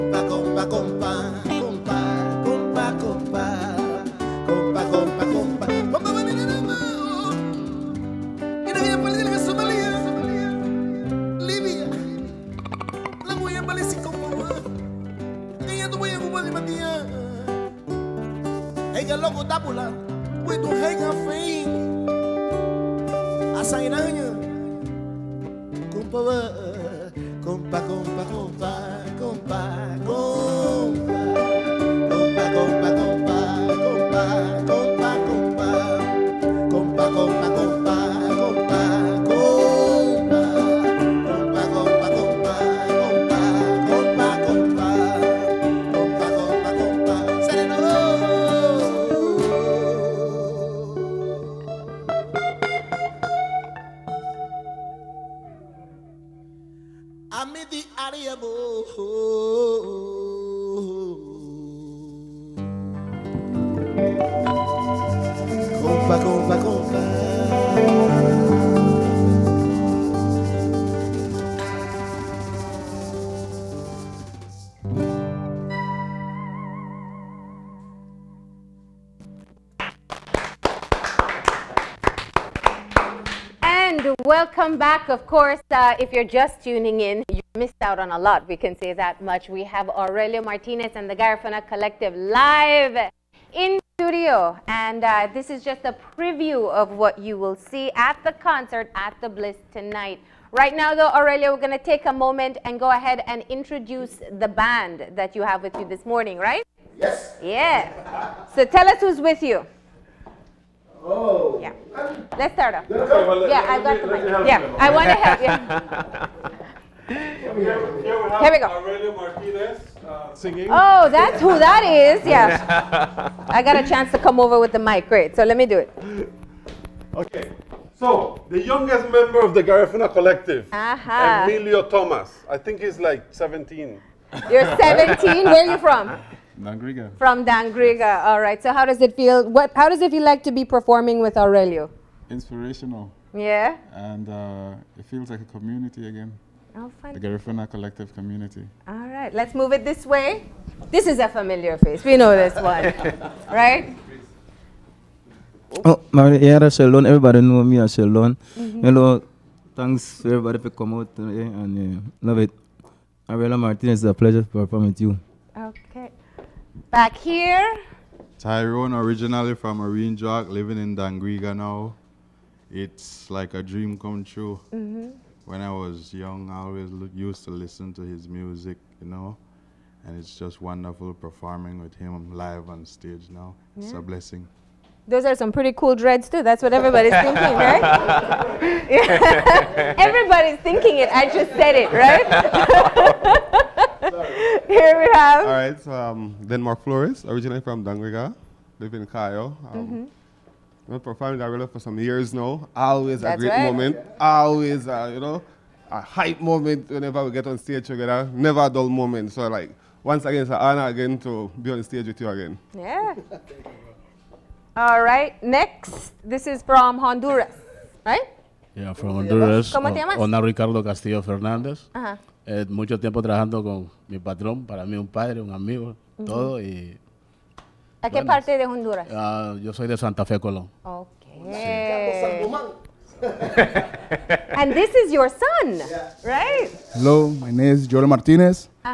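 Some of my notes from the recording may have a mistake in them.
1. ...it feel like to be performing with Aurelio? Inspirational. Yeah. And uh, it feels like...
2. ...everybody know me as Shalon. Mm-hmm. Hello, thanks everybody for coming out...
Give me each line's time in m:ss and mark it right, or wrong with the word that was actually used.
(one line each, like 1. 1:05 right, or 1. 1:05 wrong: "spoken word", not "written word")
1. 2:20 right
2. 2:37 right.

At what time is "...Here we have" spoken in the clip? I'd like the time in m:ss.
3:14.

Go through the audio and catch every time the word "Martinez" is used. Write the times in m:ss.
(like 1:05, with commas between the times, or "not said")
1:30, 1:59, 2:43, 3:58.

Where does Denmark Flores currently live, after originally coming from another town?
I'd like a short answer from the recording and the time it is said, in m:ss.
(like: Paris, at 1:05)
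Cayo, at 3:19.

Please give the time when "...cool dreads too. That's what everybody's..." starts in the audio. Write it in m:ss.
3:05.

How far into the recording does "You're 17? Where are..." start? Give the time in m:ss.
2:14.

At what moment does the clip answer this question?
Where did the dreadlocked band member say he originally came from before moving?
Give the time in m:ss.
2:49.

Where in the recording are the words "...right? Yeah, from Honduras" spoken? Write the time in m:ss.
3:38.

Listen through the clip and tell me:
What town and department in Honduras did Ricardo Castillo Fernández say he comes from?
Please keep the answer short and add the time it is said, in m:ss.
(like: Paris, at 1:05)
Santa Fe, Colón, at 3:49.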